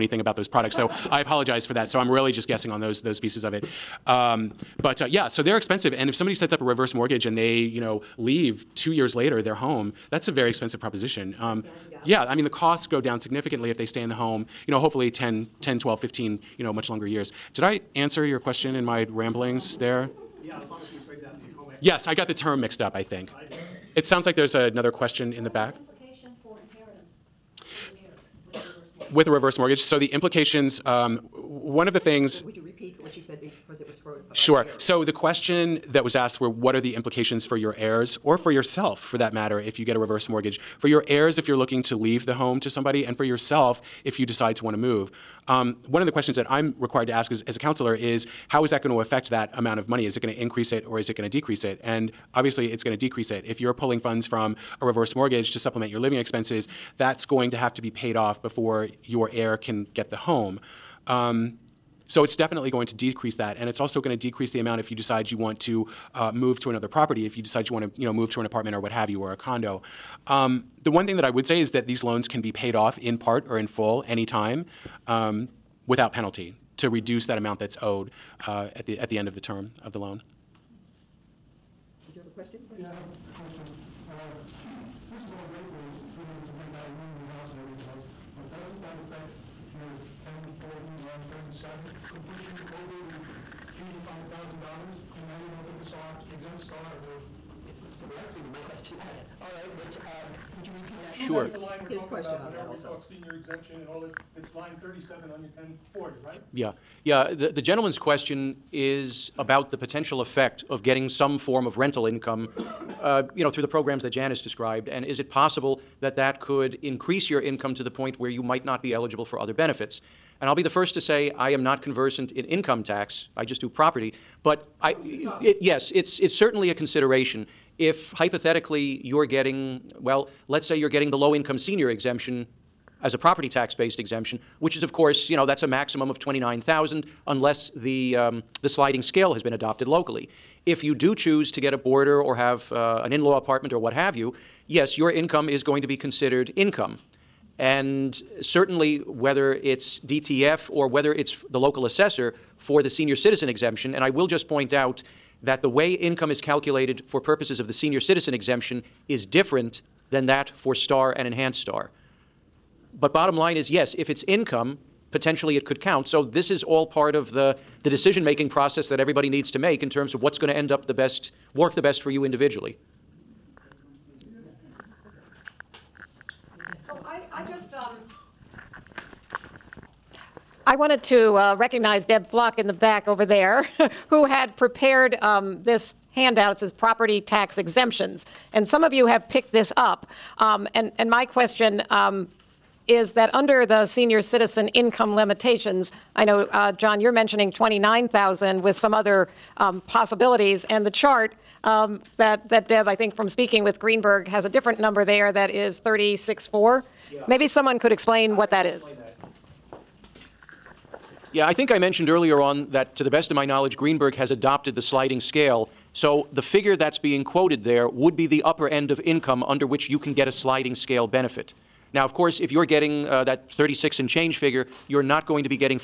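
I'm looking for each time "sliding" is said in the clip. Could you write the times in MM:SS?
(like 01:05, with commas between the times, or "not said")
02:18, 03:34, 03:40.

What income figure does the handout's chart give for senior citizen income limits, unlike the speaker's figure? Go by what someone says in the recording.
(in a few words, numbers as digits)
36.4.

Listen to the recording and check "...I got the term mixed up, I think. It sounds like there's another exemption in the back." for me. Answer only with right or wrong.
wrong.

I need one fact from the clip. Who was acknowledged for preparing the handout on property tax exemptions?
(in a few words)
Deb Flock.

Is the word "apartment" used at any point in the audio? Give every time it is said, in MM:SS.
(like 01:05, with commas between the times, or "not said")
01:08, 02:23.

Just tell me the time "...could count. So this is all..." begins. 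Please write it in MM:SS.
02:45.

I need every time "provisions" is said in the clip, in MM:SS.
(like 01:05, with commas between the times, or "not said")
not said.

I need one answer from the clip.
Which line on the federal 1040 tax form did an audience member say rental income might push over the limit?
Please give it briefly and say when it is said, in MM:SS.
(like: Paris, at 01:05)
Line 37, at 01:31.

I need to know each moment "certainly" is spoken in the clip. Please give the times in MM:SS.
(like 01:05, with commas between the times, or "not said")
02:06, 02:28.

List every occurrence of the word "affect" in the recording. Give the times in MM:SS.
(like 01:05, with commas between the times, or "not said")
00:49, 01:29.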